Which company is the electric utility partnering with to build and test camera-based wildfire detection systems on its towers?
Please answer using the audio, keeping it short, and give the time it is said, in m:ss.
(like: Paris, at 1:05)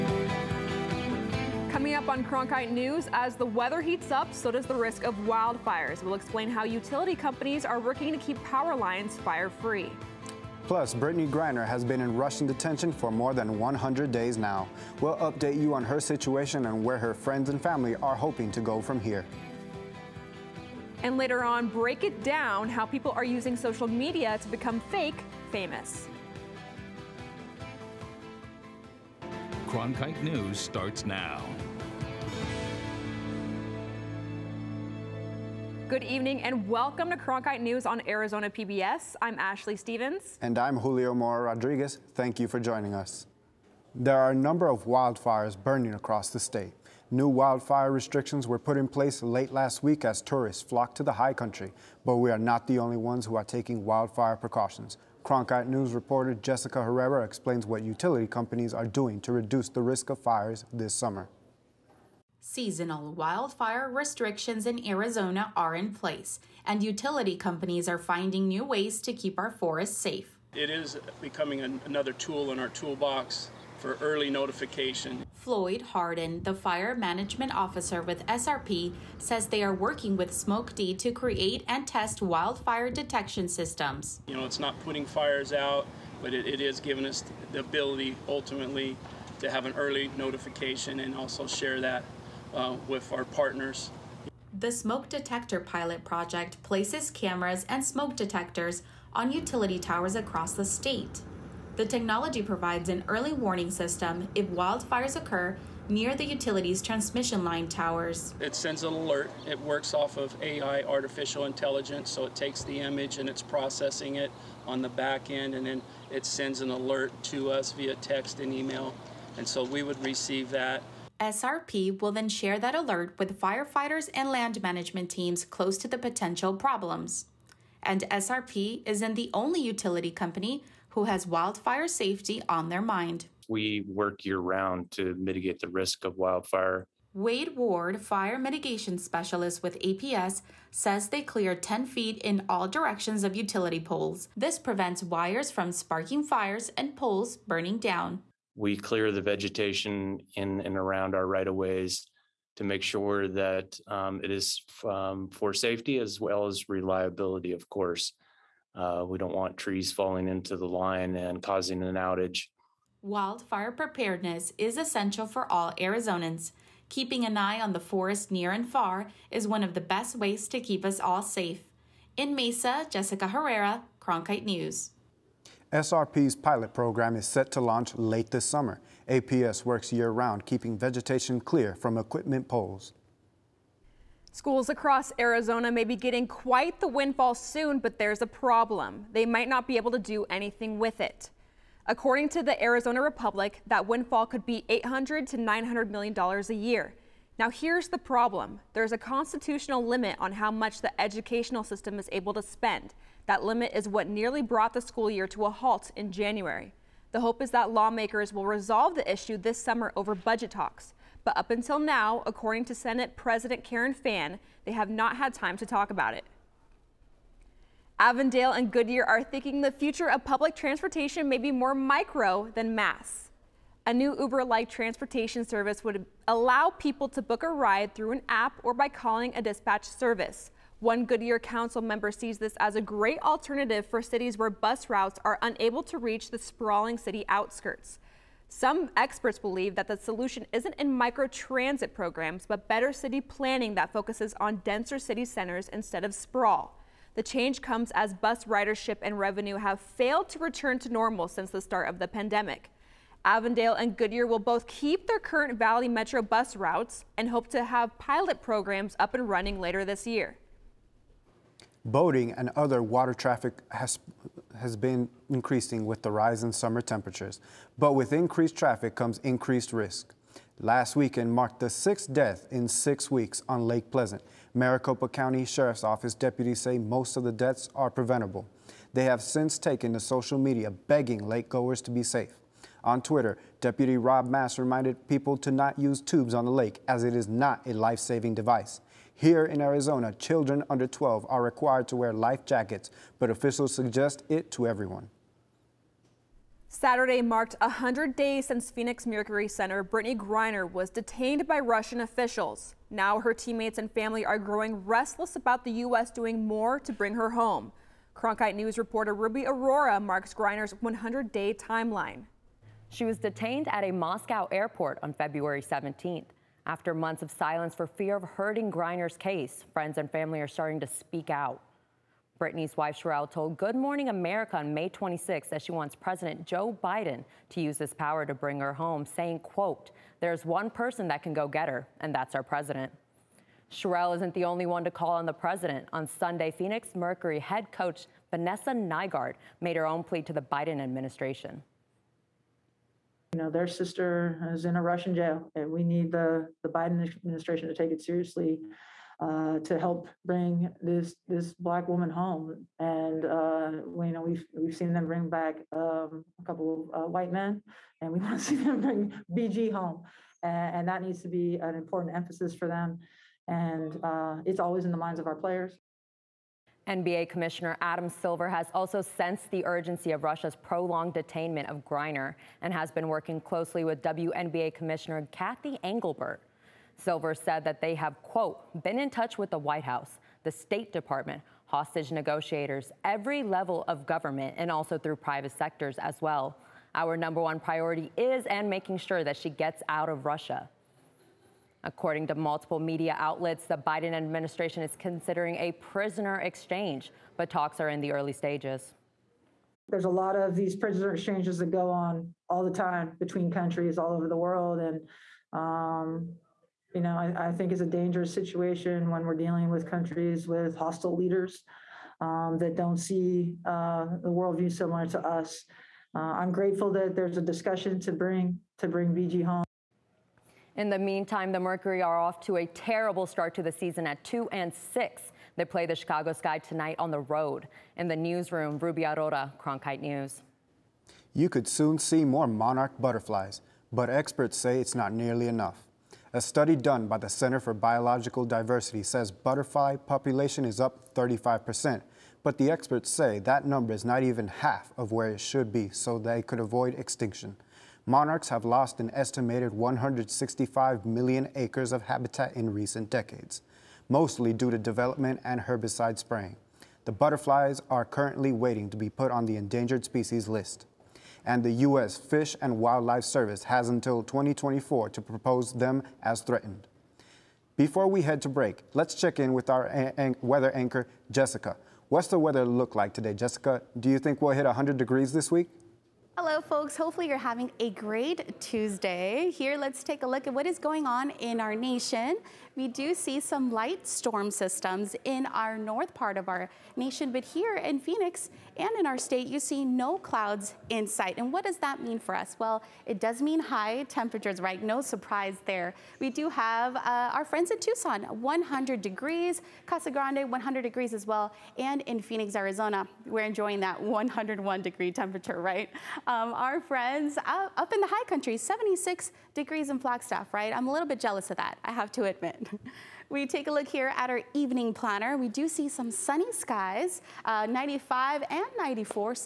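SmokeD, at 1:20.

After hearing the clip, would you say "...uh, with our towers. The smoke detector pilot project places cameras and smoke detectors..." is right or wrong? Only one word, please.
wrong.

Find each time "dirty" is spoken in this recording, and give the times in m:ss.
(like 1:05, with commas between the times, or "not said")
not said.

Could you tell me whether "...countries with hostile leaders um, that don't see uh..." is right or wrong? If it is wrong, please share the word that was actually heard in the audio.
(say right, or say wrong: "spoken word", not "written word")
right.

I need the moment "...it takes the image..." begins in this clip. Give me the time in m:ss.
1:52.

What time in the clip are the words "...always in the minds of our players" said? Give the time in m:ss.
6:04.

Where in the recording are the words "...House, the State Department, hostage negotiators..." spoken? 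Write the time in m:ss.
6:19.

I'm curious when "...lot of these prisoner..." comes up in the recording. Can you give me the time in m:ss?
6:40.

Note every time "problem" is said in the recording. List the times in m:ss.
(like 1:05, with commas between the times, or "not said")
2:06, 3:08, 3:17.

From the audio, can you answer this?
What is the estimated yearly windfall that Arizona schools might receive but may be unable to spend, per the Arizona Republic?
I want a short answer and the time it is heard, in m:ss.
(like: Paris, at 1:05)
800 to 900 million dollars, at 3:14.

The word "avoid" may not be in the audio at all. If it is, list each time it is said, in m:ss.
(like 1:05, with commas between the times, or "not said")
7:26.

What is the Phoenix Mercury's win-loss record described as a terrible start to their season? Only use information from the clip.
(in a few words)
2 and 6.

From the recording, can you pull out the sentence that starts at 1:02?
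Seasonal wildfire restrictions in Arizona are in place, and utility companies are finding new ways to keep our forests safe.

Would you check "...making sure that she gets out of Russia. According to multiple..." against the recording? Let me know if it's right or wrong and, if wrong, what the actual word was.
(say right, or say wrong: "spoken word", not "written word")
right.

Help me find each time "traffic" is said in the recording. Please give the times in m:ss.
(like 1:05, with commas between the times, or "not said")
4:23, 4:28.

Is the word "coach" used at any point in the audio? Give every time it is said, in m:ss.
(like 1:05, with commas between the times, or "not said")
5:37.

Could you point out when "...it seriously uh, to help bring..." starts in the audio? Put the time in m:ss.
5:47.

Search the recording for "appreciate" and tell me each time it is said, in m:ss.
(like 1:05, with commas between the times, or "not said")
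not said.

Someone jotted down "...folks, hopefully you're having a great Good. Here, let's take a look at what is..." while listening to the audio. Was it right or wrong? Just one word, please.
wrong.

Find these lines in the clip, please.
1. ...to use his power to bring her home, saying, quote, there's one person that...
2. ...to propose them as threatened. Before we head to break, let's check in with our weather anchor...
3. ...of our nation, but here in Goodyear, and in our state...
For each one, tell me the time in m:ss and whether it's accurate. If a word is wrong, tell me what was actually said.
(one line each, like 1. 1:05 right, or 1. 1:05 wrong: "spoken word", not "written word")
1. 5:27 right
2. 7:45 right
3. 8:06 wrong: "Phoenix", not "Goodyear".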